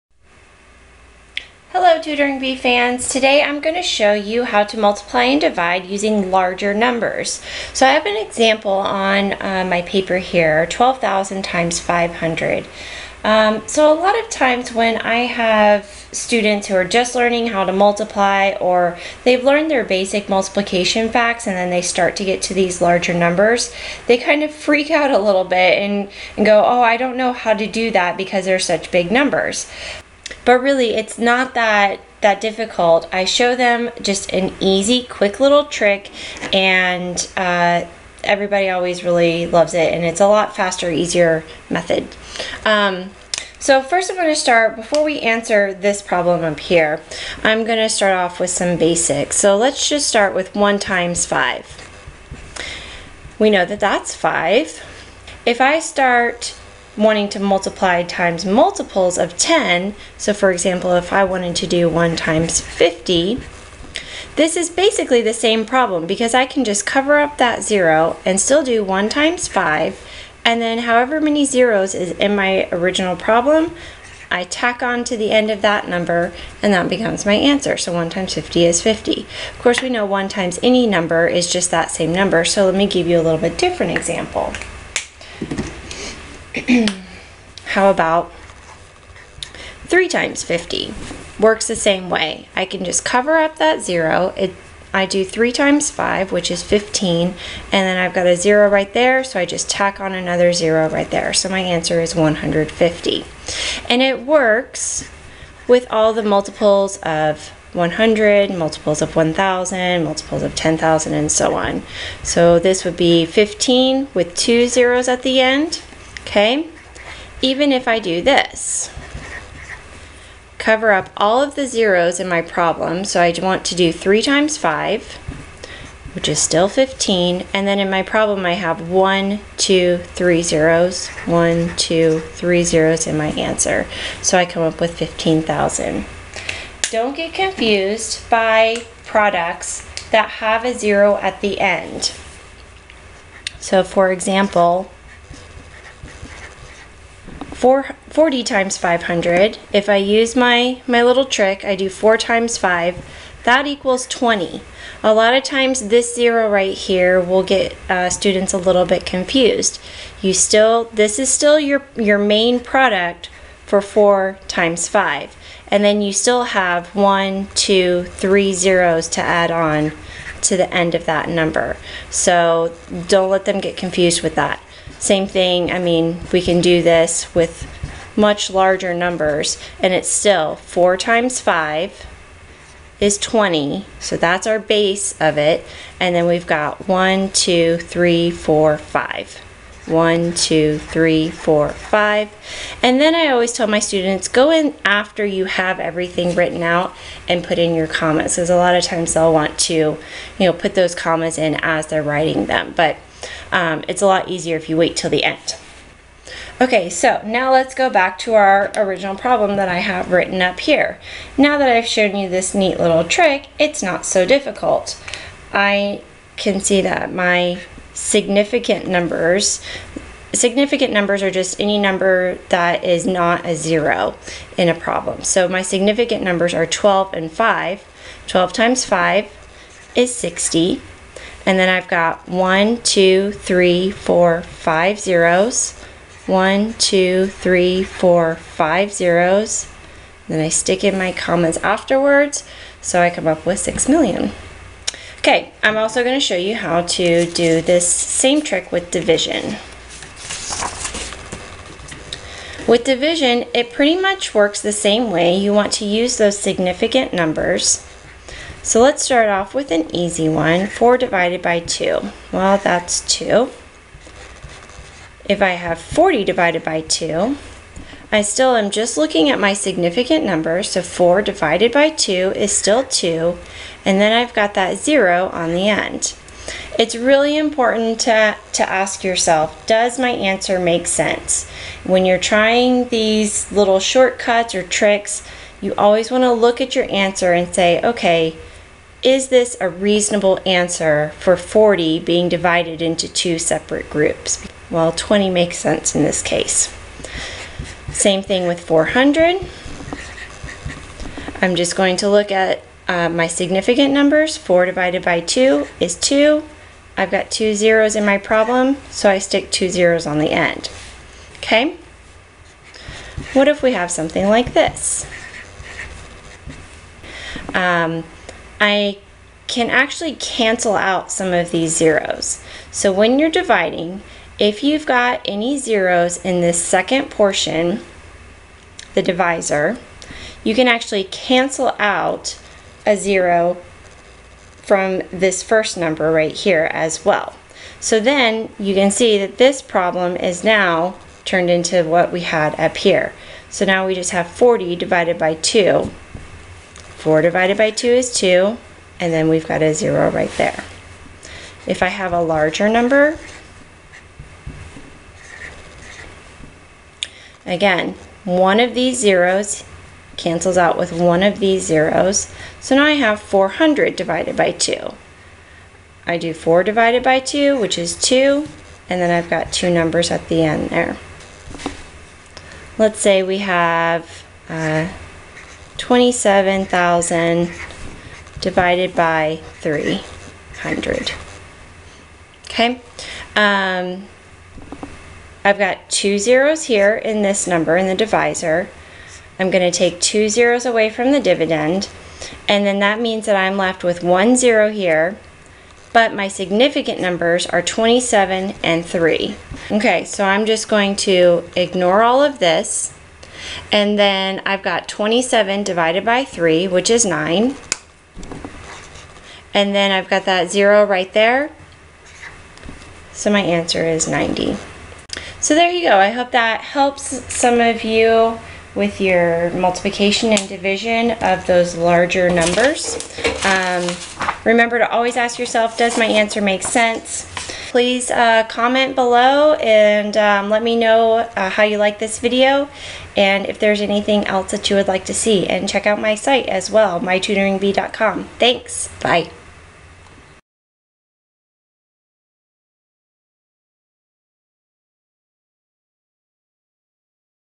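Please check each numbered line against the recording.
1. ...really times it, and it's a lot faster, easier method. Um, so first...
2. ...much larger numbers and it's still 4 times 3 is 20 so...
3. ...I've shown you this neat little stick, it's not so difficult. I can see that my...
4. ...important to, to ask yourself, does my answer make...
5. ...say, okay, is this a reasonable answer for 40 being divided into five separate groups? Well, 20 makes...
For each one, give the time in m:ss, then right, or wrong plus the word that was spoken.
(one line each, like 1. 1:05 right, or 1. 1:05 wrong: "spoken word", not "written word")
1. 0:39 wrong: "loves", not "times"
2. 2:58 wrong: "5", not "3"
3. 3:31 wrong: "trick", not "stick"
4. 4:37 right
5. 4:47 wrong: "two", not "five".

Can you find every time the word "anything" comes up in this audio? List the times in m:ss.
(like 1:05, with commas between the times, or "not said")
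7:13.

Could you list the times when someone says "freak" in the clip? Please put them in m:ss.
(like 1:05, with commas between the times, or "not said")
0:24.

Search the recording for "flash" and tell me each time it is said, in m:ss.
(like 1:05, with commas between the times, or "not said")
not said.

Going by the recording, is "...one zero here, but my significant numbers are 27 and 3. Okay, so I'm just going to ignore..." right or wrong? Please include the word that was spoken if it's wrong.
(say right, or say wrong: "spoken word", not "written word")
right.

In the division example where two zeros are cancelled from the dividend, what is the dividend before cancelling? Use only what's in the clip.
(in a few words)
27,000.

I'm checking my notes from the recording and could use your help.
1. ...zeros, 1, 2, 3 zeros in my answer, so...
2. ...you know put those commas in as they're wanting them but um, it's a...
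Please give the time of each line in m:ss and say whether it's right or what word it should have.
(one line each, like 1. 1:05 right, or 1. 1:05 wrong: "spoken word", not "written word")
1. 2:10 right
2. 3:19 wrong: "writing", not "wanting".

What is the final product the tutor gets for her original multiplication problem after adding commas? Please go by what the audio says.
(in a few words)
6,000,000.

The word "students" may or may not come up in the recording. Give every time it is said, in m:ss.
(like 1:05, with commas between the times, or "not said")
0:16, 2:38, 3:13.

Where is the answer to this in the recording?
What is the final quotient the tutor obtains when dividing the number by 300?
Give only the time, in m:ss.
6:54.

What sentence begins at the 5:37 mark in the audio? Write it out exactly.
So then you can see that this problem is now turned into what we had up here.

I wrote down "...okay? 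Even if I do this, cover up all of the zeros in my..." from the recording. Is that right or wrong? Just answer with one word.
right.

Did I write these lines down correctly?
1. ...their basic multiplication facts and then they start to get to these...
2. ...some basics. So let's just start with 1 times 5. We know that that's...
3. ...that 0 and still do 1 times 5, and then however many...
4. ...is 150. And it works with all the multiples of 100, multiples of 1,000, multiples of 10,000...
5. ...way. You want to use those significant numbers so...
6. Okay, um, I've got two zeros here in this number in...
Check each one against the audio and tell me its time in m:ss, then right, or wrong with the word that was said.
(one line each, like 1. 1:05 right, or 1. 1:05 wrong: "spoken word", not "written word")
1. 0:19 right
2. 0:48 right
3. 1:07 right
4. 1:42 right
5. 4:15 right
6. 6:22 right.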